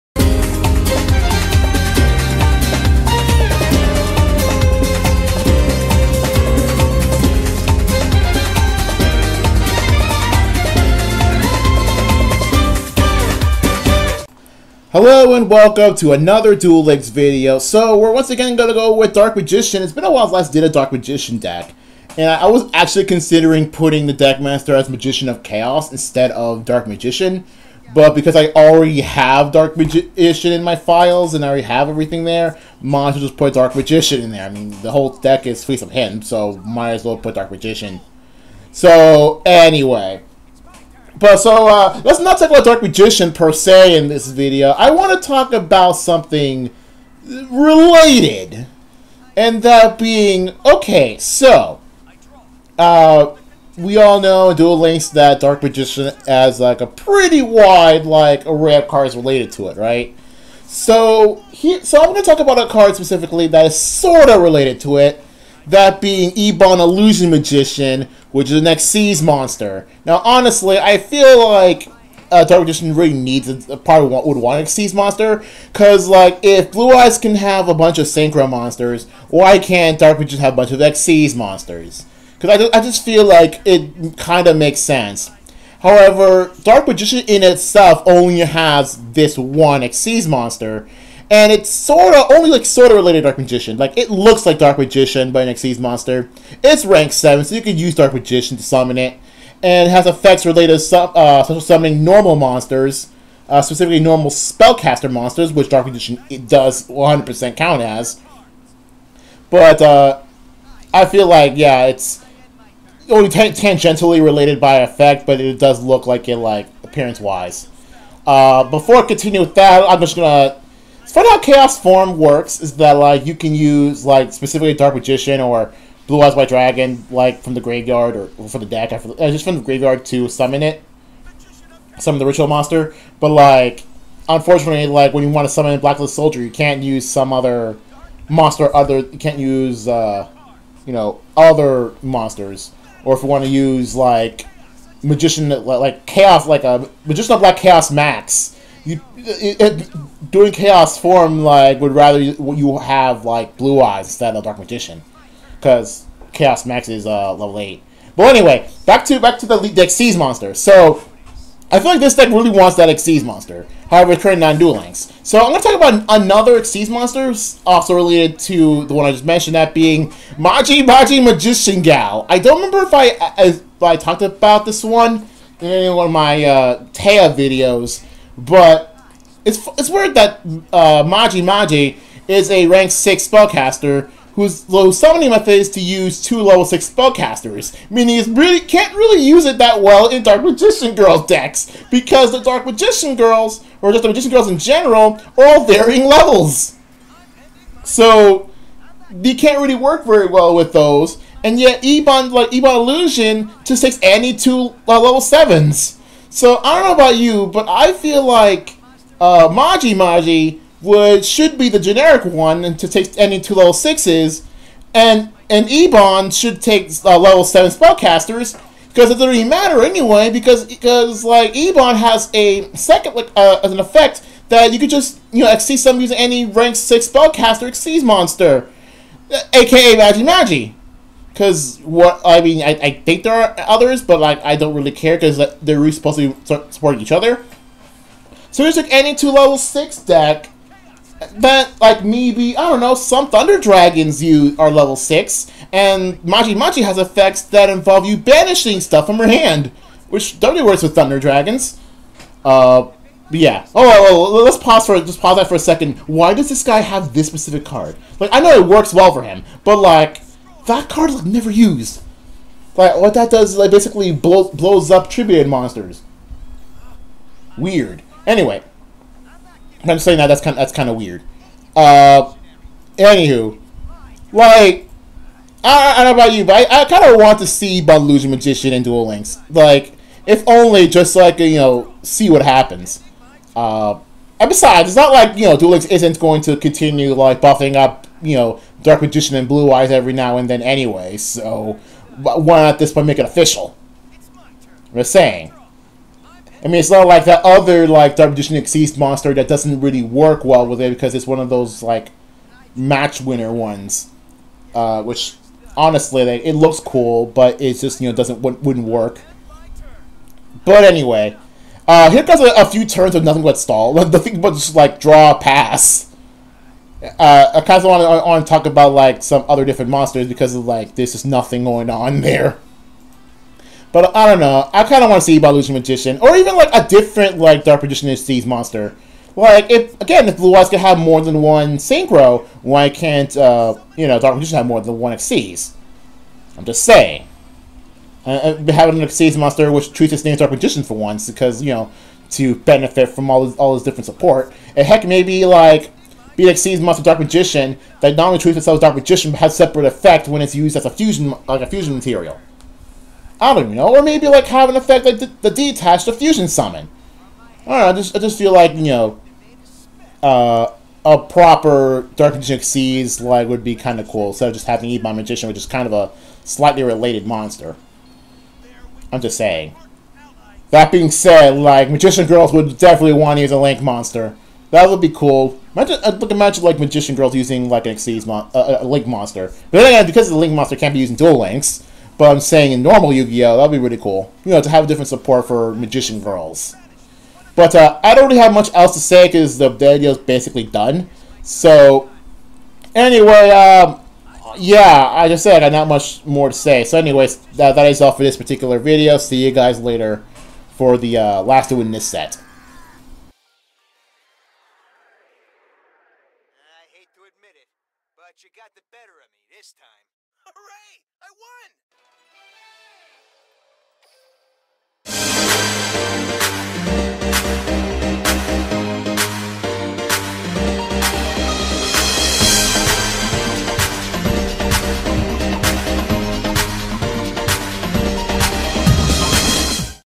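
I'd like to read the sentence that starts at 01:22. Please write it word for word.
Because I, I just feel like it kind of makes sense.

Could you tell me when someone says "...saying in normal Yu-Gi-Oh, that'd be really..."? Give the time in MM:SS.
06:22.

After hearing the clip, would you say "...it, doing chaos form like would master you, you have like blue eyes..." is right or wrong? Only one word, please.
wrong.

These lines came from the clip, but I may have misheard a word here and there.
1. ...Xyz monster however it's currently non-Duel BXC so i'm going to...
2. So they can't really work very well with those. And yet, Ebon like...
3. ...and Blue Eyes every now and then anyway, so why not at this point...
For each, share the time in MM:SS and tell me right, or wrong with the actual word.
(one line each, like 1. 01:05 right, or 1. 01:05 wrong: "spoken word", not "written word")
1. 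02:42 wrong: "Links", not "BXC"
2. 03:17 right
3. 04:49 right.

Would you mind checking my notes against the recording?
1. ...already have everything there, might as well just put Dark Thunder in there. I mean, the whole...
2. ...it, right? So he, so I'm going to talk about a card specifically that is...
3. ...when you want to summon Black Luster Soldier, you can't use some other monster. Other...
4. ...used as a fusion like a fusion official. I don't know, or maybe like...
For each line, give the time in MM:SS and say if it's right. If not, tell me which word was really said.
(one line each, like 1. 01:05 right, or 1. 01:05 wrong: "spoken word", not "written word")
1. 00:31 wrong: "Magician", not "Thunder"
2. 00:59 right
3. 02:15 right
4. 05:50 wrong: "material", not "official".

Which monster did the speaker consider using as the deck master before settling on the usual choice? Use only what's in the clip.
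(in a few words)
Magician of Chaos.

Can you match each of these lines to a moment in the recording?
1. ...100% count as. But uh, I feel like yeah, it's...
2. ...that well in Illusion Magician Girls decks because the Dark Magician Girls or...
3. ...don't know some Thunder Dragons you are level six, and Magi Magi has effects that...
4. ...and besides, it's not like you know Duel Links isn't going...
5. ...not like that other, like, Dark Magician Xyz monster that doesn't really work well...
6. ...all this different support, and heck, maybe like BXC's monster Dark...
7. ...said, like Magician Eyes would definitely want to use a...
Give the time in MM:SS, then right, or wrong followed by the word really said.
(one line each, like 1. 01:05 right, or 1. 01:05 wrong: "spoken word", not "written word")
1. 01:46 right
2. 03:09 wrong: "Dark", not "Illusion"
3. 04:02 right
4. 04:44 right
5. 04:56 right
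6. 05:43 right
7. 06:11 wrong: "Girls", not "Eyes".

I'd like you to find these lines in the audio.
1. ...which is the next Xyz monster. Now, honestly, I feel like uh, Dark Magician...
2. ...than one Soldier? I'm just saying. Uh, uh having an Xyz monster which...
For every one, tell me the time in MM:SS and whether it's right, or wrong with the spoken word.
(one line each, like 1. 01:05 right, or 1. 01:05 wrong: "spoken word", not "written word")
1. 01:08 right
2. 05:34 wrong: "Xyz", not "Soldier".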